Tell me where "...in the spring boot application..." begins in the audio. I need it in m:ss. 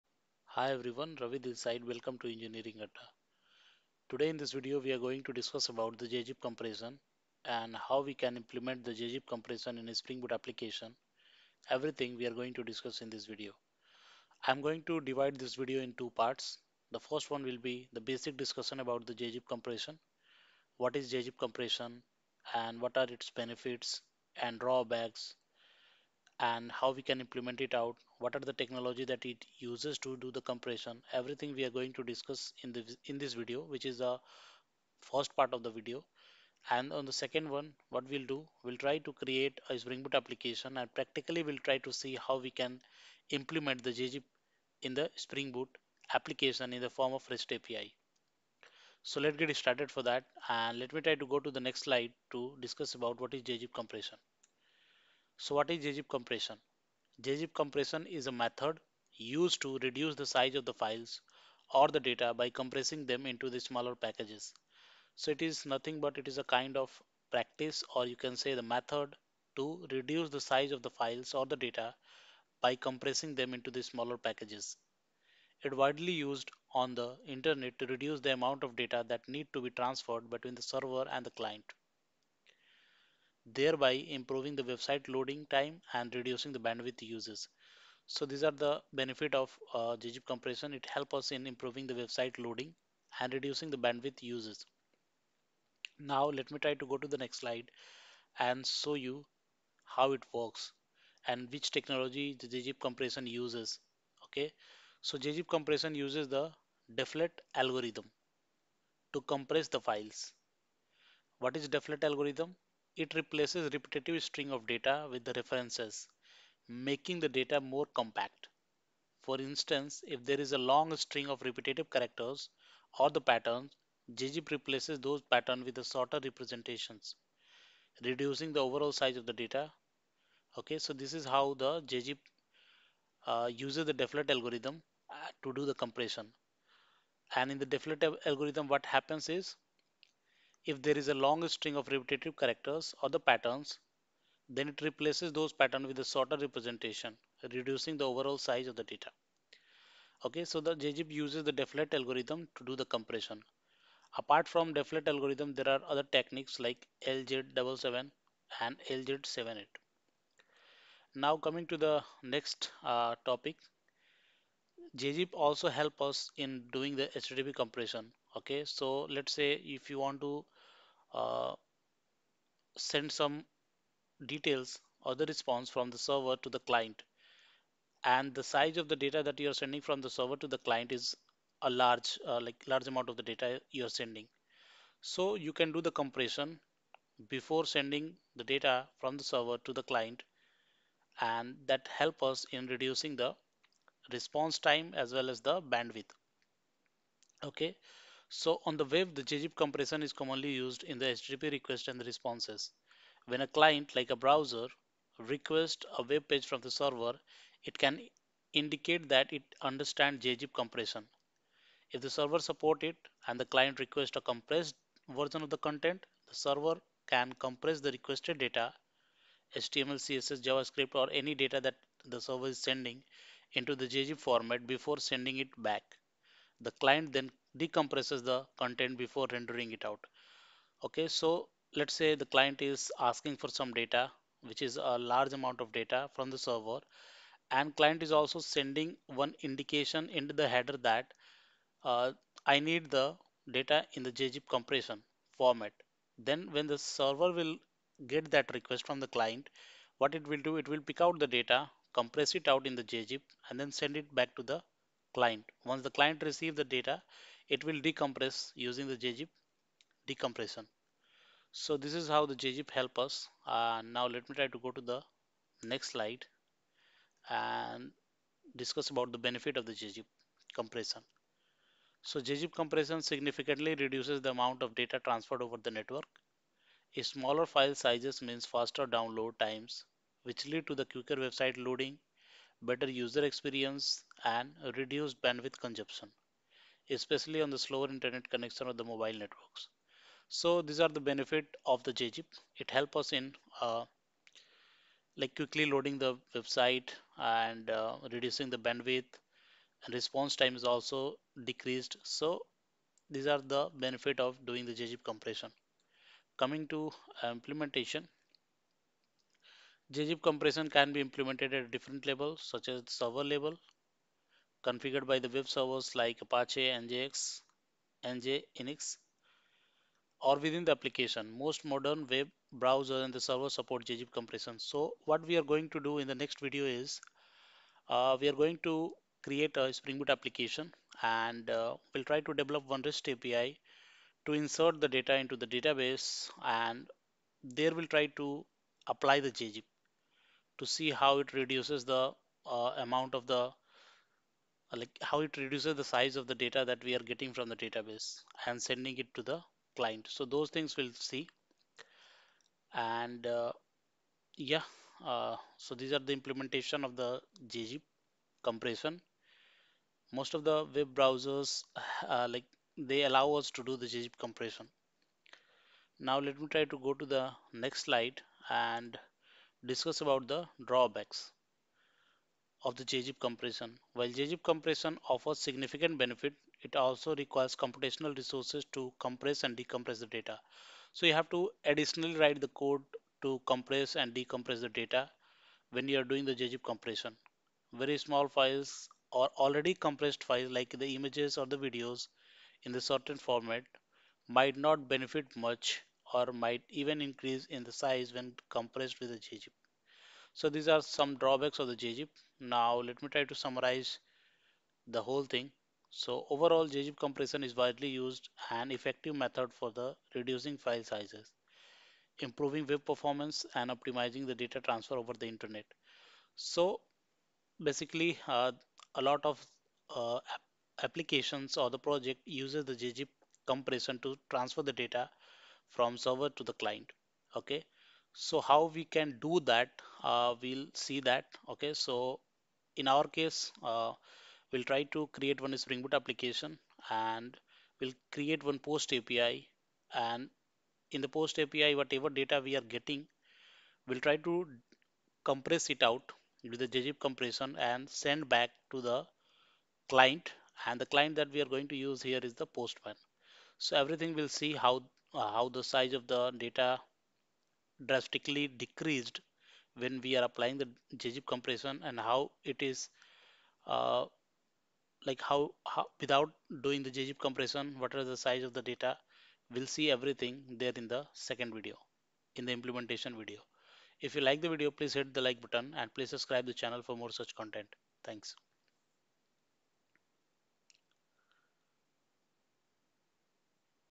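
0:44.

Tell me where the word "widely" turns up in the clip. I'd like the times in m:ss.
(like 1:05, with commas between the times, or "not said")
1:15, 6:47.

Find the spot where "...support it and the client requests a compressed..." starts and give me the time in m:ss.
3:32.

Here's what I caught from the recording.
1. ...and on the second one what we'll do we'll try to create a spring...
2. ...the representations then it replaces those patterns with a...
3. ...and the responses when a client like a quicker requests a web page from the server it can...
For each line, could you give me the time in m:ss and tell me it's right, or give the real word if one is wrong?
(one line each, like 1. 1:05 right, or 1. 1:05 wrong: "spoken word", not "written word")
1. 0:36 right
2. 2:23 wrong: "patterns", not "representations"
3. 3:21 wrong: "browser", not "quicker".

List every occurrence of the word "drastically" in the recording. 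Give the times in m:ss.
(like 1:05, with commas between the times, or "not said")
7:37.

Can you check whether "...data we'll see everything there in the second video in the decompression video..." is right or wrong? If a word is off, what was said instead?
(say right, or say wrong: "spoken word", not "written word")
wrong: "implementation", not "decompression".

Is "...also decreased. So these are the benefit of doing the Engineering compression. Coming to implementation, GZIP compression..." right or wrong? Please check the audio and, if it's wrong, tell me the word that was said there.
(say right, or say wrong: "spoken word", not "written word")
wrong: "GZIP", not "Engineering".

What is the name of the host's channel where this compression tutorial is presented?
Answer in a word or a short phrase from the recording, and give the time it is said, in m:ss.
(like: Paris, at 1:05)
Engineering Adda, at 0:02.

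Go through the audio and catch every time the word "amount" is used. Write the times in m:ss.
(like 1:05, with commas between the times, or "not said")
1:18, 3:02, 3:55, 4:34, 5:42.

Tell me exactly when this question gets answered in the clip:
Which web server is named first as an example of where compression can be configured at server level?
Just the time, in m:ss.
5:16.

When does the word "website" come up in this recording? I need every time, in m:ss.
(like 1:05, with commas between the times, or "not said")
1:24, 1:31, 4:41, 4:56.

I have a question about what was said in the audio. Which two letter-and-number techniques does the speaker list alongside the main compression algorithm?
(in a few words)
LZ77 and LZ78.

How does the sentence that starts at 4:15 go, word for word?
Once the client receives the data, it will decompress using the GZIP decompression.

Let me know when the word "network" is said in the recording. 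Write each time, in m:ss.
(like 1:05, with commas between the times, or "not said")
4:35, 4:49.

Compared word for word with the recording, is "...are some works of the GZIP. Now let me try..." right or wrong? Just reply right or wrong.
wrong.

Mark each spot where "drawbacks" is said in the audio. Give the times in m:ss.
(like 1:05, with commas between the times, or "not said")
0:24, 6:10, 6:41.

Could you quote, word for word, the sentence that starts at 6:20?
So you have to additionally write the code to compress and decompress the data when you are doing the GZIP compression.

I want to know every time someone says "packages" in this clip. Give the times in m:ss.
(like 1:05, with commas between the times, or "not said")
1:03, 1:14.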